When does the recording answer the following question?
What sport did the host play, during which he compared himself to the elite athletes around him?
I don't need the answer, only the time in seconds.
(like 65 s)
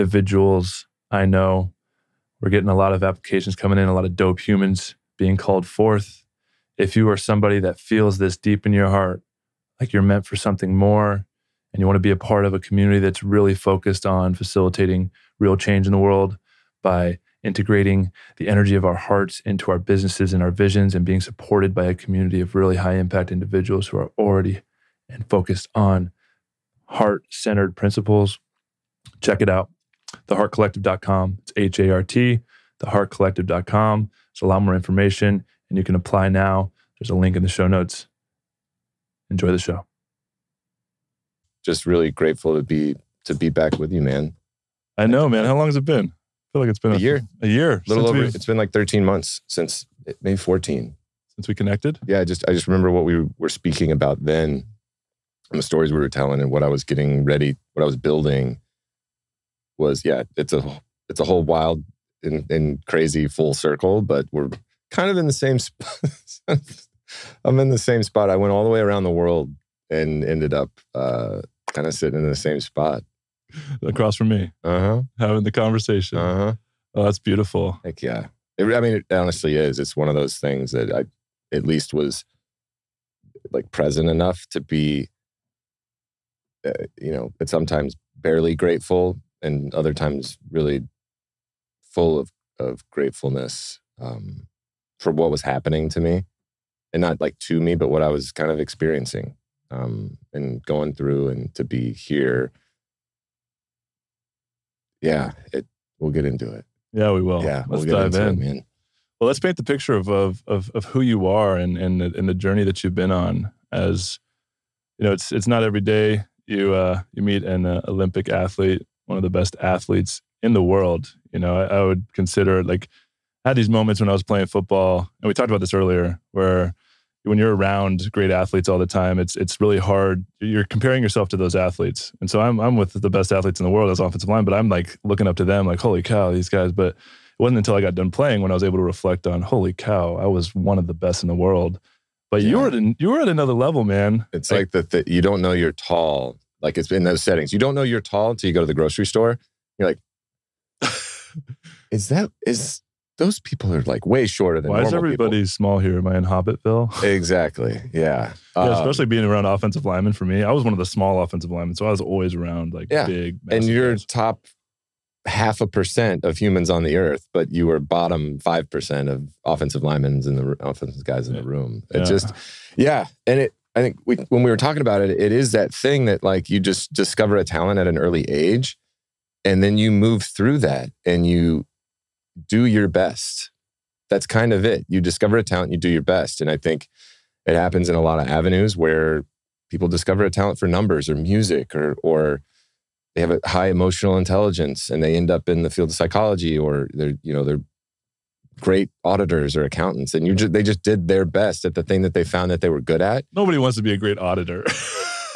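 124 s.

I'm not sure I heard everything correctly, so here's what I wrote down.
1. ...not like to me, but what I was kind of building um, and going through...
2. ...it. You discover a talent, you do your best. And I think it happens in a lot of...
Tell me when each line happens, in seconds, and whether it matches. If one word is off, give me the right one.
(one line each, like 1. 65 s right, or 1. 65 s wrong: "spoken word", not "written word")
1. 97 s wrong: "experiencing", not "building"
2. 184 s right.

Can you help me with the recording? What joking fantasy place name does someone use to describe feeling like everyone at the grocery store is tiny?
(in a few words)
Hobbitville.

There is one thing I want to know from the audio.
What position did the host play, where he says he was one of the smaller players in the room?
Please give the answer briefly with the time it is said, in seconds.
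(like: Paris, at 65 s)
offensive line, at 133 s.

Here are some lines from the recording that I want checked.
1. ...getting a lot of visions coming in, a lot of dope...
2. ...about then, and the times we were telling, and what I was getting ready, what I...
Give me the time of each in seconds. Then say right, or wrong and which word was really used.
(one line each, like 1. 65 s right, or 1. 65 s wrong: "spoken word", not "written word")
1. 2 s wrong: "applications", not "visions"
2. 53 s wrong: "stories", not "times".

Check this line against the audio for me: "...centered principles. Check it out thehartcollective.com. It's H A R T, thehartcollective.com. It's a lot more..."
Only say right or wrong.
right.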